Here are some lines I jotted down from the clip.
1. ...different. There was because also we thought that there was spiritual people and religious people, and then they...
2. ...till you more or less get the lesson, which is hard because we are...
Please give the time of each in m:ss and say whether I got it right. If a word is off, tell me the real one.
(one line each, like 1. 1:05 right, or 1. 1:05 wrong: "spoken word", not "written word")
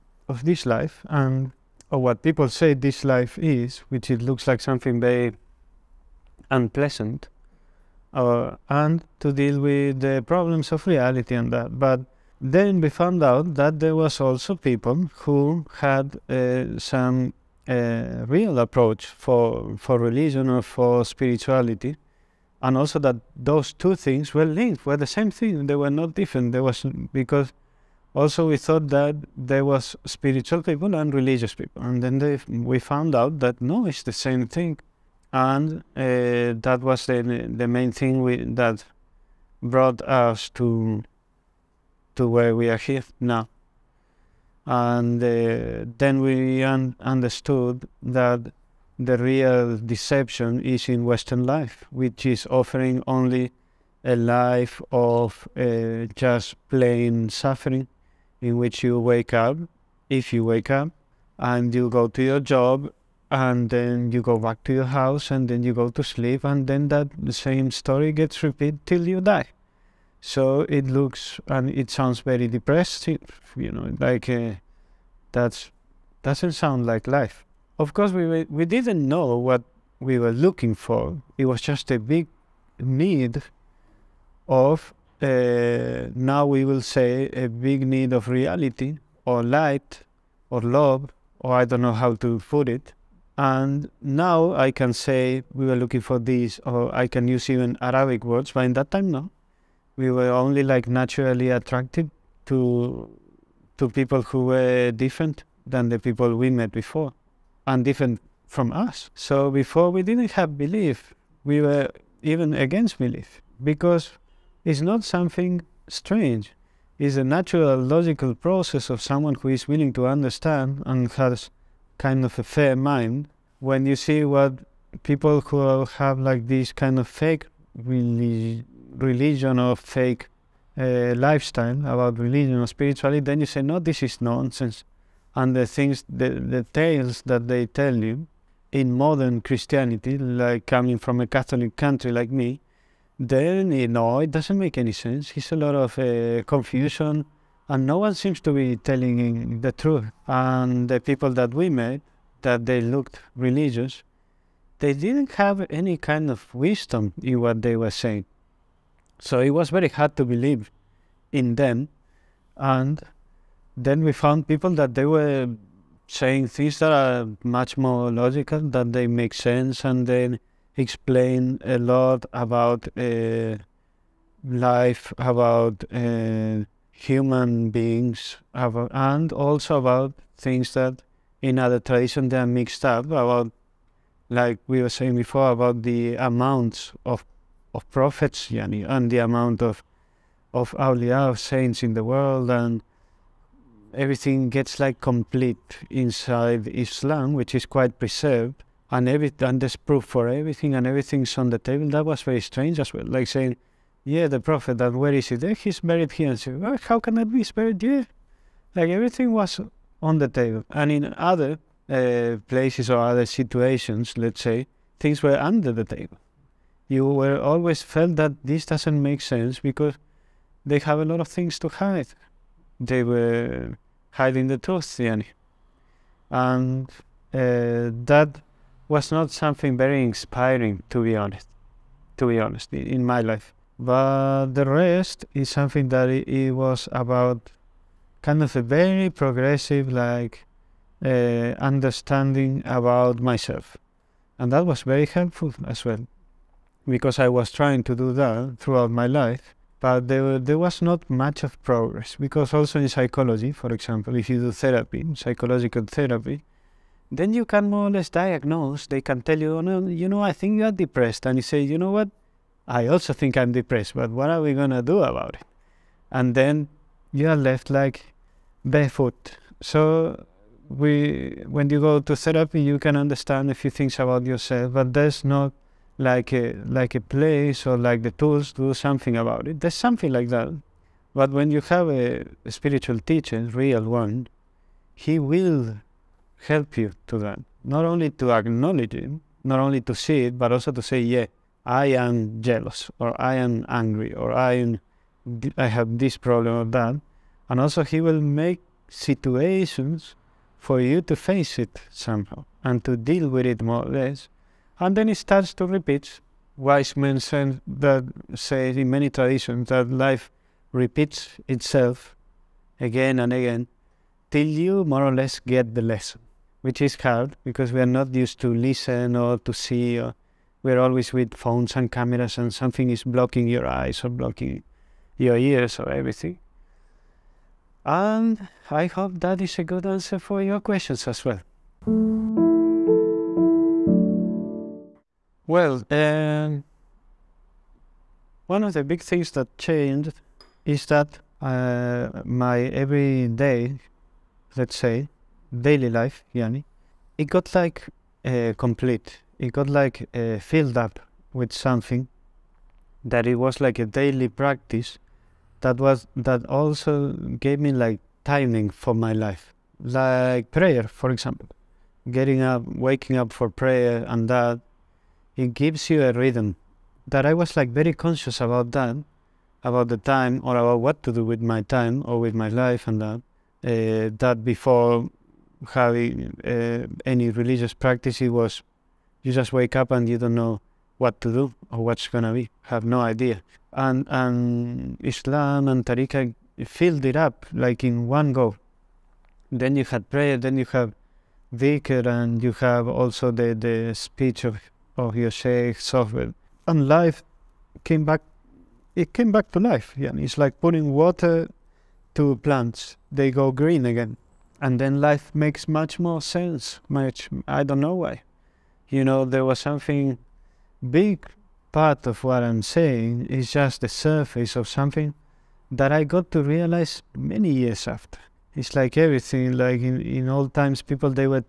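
1. 0:26 right
2. 5:14 right.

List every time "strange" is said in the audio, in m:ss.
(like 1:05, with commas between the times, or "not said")
1:55, 3:22.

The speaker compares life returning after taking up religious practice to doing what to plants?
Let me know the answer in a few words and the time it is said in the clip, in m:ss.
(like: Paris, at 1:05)
putting water, at 6:40.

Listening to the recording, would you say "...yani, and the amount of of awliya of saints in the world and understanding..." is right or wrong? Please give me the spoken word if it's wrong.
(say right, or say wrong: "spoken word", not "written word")
wrong: "everything", not "understanding".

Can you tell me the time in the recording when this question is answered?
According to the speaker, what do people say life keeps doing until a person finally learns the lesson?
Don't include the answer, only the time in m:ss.
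5:10.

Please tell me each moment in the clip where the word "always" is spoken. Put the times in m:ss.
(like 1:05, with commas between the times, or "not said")
3:37, 5:20.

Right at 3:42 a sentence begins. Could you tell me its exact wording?
They were hiding the truth, yani.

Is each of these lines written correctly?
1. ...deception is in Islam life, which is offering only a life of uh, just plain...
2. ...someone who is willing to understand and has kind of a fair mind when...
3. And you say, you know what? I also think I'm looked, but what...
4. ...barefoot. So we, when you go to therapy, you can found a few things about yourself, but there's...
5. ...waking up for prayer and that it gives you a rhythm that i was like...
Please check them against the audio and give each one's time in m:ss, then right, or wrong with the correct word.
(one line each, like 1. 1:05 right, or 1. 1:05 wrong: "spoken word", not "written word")
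1. 0:49 wrong: "Western", not "Islam"
2. 1:58 right
3. 4:21 wrong: "depressed", not "looked"
4. 4:28 wrong: "understand", not "found"
5. 6:02 right.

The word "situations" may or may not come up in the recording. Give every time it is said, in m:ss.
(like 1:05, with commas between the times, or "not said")
3:33, 4:58.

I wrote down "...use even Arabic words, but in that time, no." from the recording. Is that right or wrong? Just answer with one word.
right.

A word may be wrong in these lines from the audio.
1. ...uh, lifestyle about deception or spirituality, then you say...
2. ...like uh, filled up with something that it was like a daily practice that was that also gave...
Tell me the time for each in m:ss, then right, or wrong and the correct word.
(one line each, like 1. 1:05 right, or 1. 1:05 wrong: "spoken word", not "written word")
1. 2:10 wrong: "religion", not "deception"
2. 5:49 right.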